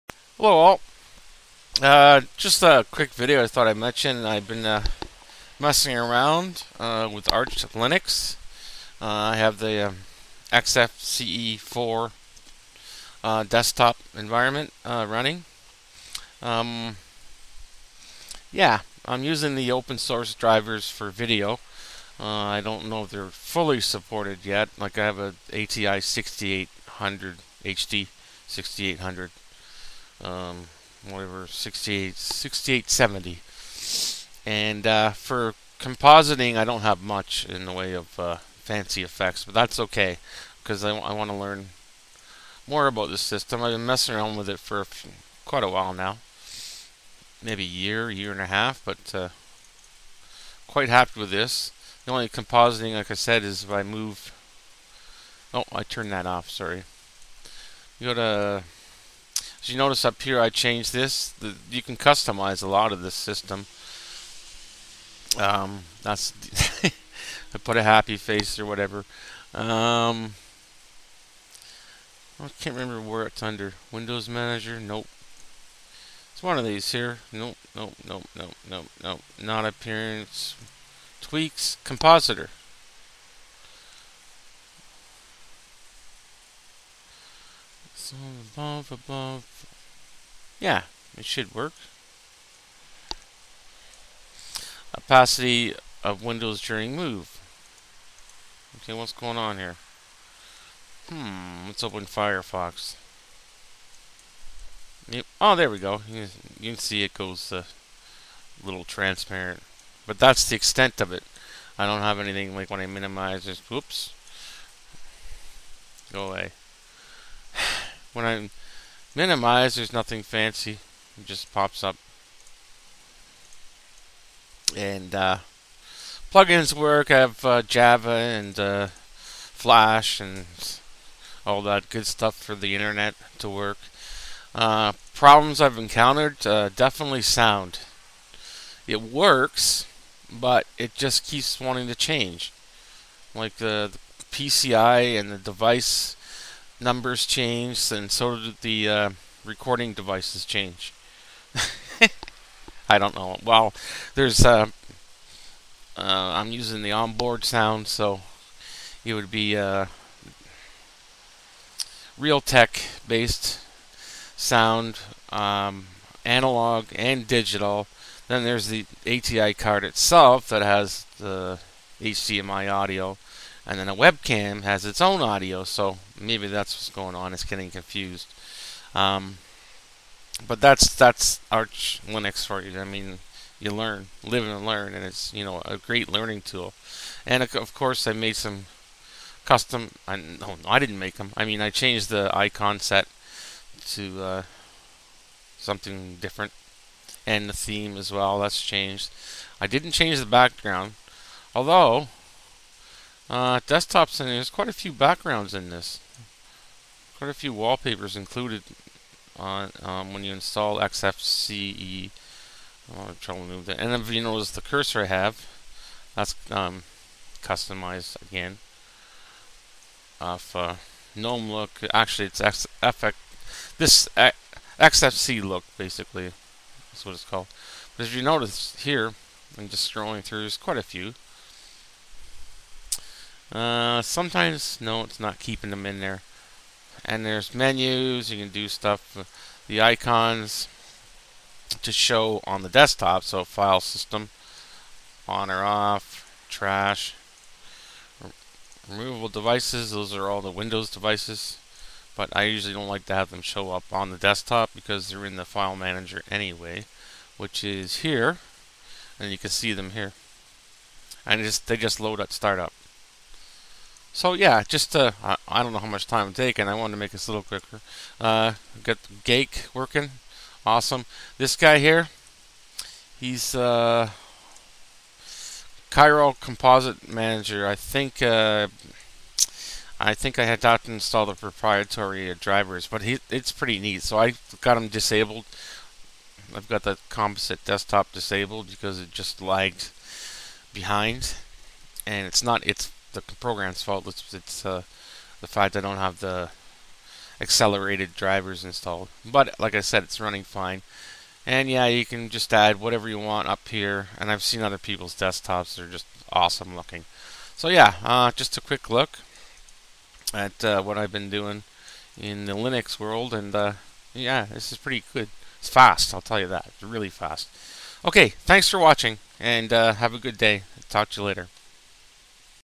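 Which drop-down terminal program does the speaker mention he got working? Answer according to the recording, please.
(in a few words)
Guake.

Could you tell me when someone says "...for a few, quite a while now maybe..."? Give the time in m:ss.
0:44.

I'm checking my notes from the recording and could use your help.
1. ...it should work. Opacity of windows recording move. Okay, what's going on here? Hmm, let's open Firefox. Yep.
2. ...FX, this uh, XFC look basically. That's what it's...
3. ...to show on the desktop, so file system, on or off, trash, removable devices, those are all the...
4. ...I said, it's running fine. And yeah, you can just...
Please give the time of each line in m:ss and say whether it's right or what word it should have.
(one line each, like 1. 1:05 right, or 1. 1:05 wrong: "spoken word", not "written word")
1. 1:31 wrong: "during", not "recording"
2. 3:42 right
3. 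4:01 right
4. 4:59 right.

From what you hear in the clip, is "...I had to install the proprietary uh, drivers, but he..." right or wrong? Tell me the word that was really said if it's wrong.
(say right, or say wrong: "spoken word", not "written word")
right.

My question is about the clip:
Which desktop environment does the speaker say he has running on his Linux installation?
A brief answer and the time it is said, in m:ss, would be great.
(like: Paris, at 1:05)
XFCE4, at 0:10.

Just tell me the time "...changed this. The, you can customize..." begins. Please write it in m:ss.
1:00.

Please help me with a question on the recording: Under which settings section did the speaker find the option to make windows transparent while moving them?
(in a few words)
Compositor.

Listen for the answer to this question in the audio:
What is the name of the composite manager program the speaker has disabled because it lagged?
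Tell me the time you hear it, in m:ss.
4:35.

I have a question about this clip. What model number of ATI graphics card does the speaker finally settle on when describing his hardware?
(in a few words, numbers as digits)
6870.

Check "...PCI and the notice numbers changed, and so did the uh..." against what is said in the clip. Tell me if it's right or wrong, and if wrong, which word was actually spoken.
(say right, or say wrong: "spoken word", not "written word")
wrong: "device", not "notice".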